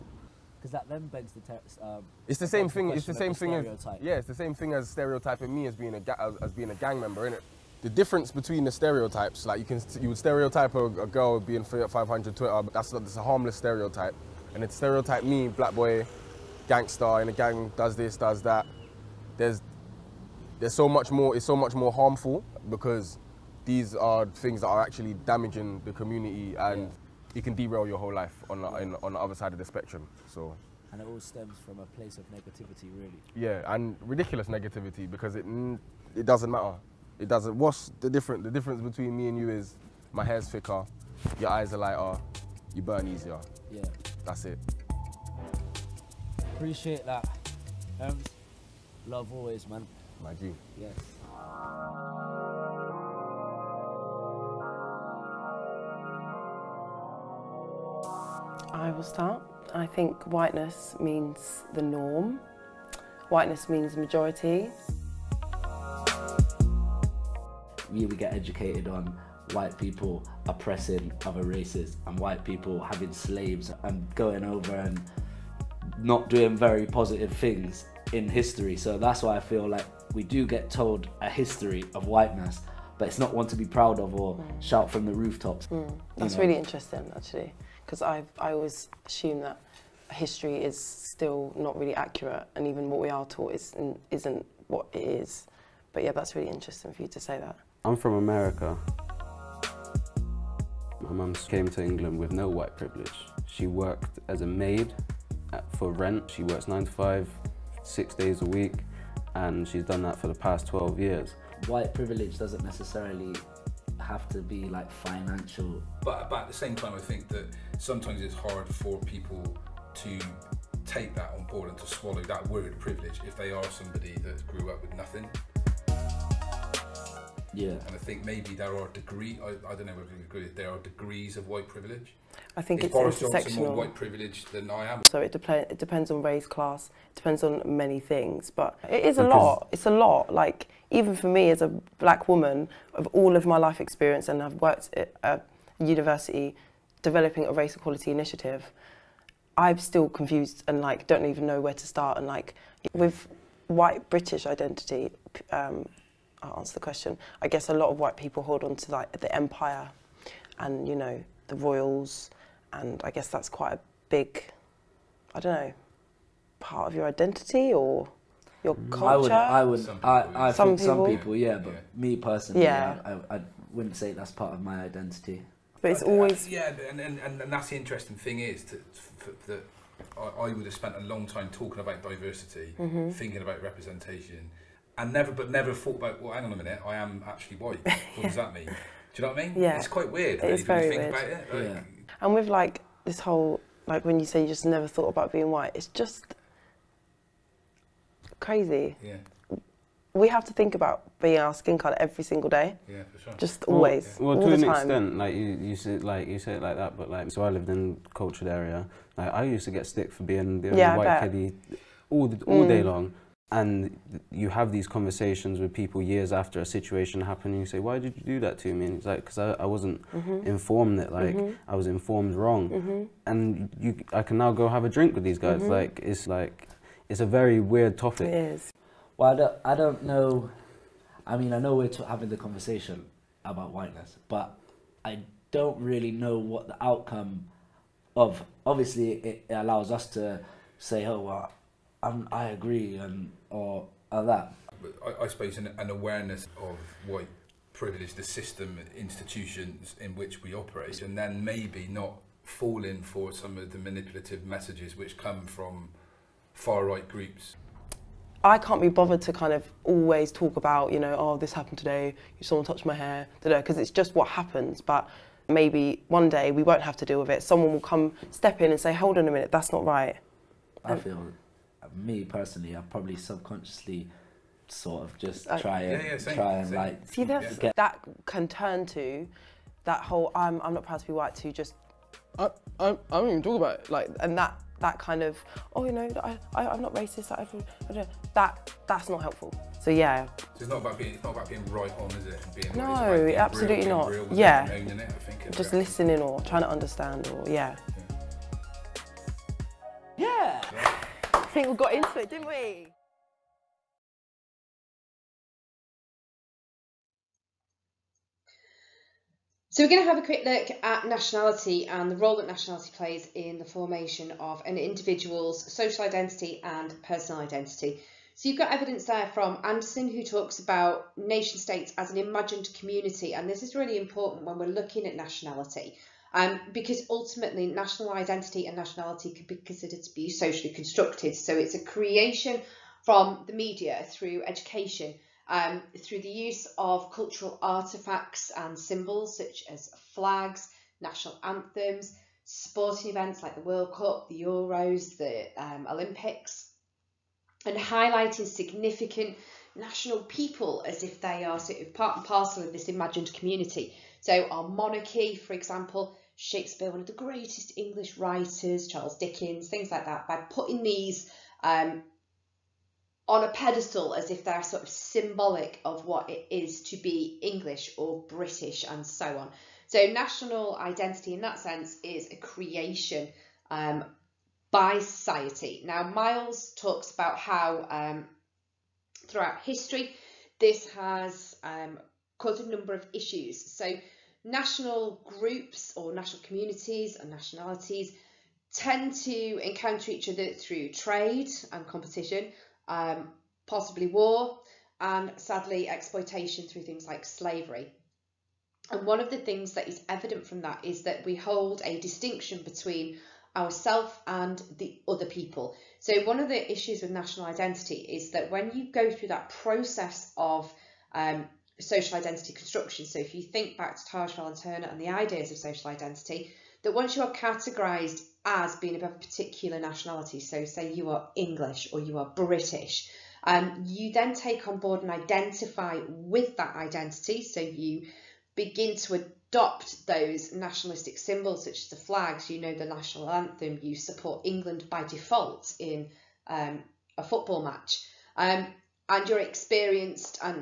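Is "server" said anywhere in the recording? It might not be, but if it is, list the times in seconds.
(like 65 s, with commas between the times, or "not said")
not said.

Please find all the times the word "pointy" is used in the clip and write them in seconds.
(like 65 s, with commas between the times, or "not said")
not said.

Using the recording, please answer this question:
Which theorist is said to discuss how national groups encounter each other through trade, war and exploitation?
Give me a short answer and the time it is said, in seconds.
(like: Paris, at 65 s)
Miles, at 376 s.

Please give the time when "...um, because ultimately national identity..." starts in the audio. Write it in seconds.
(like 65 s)
326 s.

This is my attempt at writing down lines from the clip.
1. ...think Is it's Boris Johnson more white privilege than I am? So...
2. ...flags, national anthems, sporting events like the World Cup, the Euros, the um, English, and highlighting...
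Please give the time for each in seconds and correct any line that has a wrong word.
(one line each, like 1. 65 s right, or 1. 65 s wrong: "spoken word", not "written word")
1. 132 s right
2. 340 s wrong: "Olympics", not "English".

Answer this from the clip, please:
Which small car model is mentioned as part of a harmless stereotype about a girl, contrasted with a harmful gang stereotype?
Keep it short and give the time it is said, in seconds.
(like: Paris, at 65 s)
Fiat 500, at 11 s.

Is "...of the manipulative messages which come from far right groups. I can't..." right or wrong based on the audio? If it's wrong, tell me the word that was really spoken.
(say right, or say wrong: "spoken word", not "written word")
right.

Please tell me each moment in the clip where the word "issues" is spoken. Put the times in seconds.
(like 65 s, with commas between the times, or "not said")
383 s, 406 s.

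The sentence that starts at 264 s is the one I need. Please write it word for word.
But maybe one day we won't have to deal with it.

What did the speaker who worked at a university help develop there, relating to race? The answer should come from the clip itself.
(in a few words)
a race equality initiative.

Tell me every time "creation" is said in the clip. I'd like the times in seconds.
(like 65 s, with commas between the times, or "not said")
331 s, 372 s.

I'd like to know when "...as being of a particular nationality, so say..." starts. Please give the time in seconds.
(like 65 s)
418 s.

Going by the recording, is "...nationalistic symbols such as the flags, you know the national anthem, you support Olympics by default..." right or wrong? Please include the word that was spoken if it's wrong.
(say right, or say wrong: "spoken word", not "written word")
wrong: "England", not "Olympics".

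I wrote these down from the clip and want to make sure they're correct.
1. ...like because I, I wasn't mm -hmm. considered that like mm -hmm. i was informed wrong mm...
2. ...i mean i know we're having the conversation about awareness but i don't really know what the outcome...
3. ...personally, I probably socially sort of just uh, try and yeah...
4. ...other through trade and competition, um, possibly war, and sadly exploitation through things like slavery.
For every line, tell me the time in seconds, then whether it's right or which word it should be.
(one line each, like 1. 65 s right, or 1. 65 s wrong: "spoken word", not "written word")
1. 219 s wrong: "informed", not "considered"
2. 231 s wrong: "whiteness", not "awareness"
3. 272 s wrong: "subconsciously", not "socially"
4. 390 s right.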